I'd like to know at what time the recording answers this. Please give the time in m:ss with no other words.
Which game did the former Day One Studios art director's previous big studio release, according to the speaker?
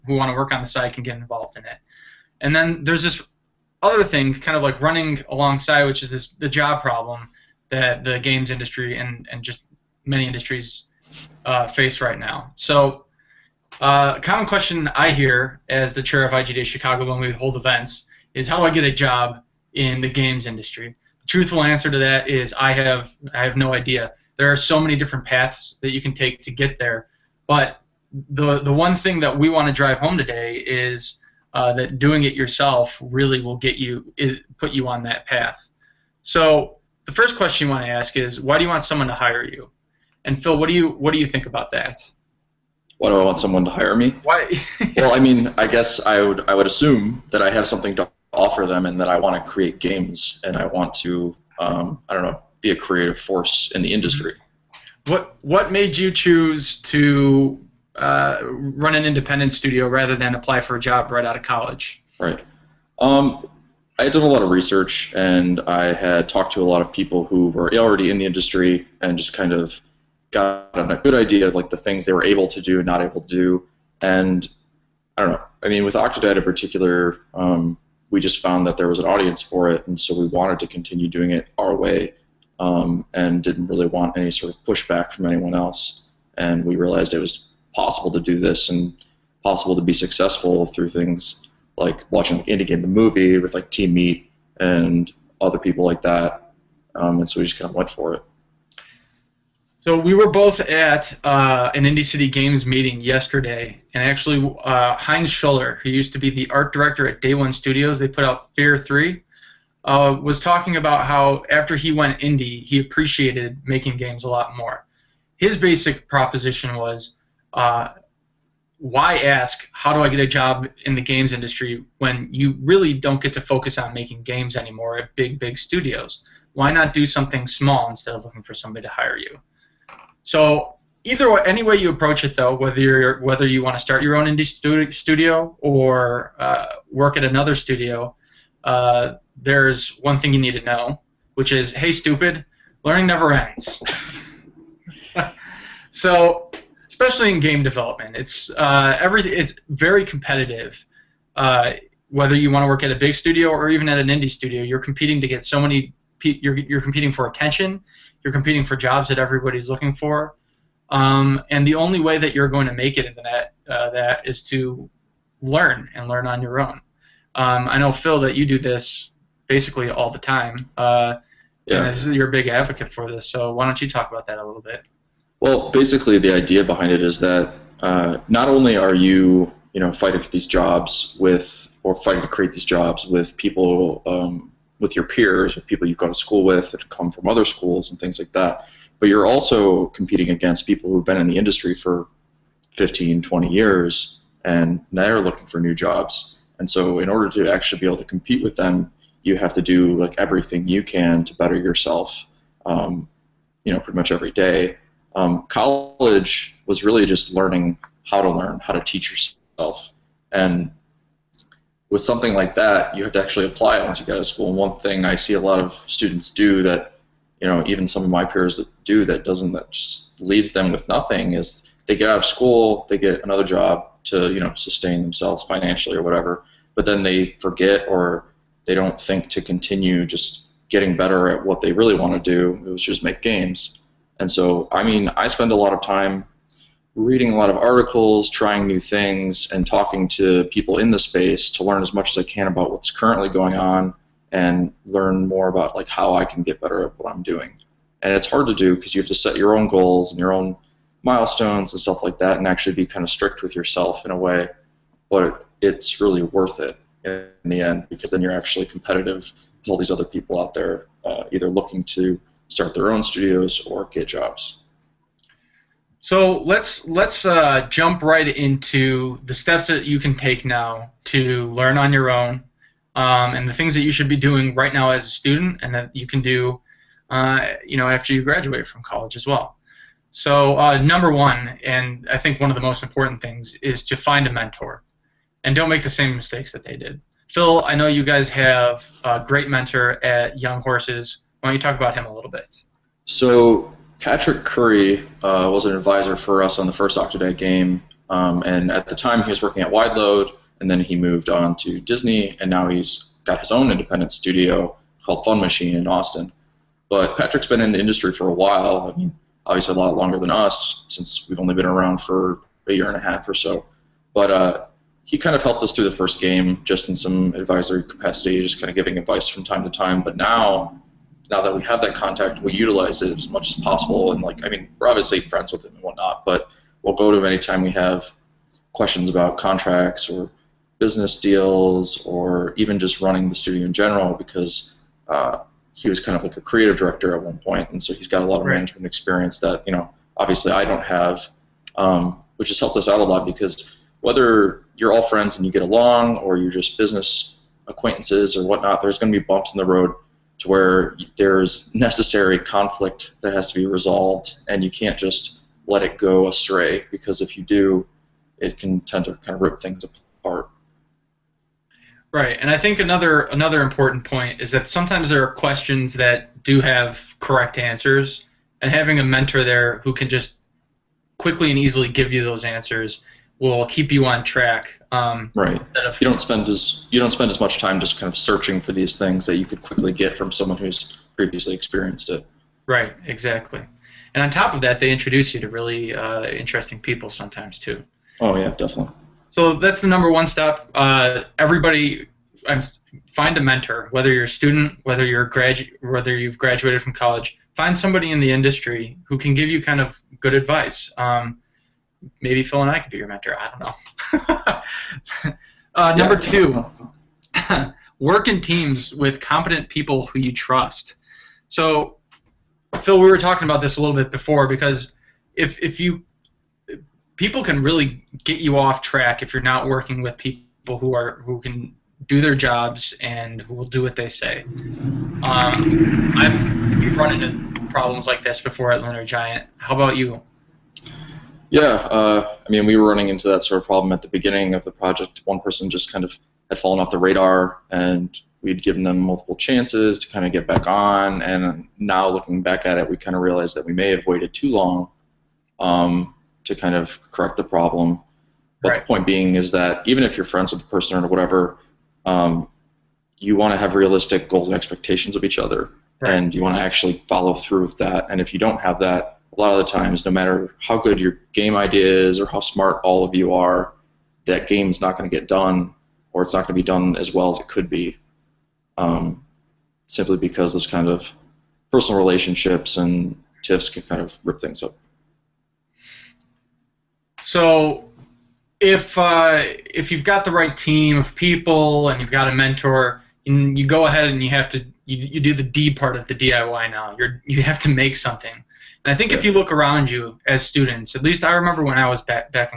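1:48.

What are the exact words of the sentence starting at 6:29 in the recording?
So that's the number one step.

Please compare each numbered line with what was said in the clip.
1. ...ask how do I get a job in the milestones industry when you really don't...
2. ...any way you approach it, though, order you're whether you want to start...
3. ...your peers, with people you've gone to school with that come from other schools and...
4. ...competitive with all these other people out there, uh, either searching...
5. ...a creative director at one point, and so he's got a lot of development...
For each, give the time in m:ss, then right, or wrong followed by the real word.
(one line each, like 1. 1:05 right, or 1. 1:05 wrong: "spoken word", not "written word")
1. 1:59 wrong: "games", not "milestones"
2. 2:11 wrong: "whether", not "order"
3. 3:04 right
4. 4:18 wrong: "looking", not "searching"
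5. 5:36 wrong: "management", not "development".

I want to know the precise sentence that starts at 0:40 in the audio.
And Phil, what do you what do you think about that?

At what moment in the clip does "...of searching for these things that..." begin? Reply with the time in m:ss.
6:18.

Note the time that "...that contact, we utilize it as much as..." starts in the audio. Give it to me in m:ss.
5:21.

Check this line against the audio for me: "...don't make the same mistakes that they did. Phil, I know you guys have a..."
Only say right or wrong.
right.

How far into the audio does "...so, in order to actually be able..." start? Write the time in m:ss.
3:16.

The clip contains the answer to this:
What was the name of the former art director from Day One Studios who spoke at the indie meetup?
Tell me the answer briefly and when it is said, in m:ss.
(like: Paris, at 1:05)
Heinz Schuller, at 1:44.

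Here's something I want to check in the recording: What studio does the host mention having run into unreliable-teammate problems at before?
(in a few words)
Lunar Giant.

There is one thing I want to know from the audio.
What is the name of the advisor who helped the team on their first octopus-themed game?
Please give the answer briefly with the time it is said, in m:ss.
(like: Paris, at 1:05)
Patrick Curry, at 4:54.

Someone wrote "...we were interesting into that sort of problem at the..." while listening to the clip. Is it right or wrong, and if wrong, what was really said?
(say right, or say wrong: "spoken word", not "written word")
wrong: "running", not "interesting".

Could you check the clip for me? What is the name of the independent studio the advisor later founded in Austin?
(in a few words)
Fun Machine.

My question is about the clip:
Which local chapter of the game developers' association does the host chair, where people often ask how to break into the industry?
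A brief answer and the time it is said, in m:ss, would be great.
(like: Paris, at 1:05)
IGDA Chicago, at 0:16.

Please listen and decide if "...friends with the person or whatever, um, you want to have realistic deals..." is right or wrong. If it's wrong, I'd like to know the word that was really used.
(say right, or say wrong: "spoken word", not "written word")
wrong: "goals", not "deals".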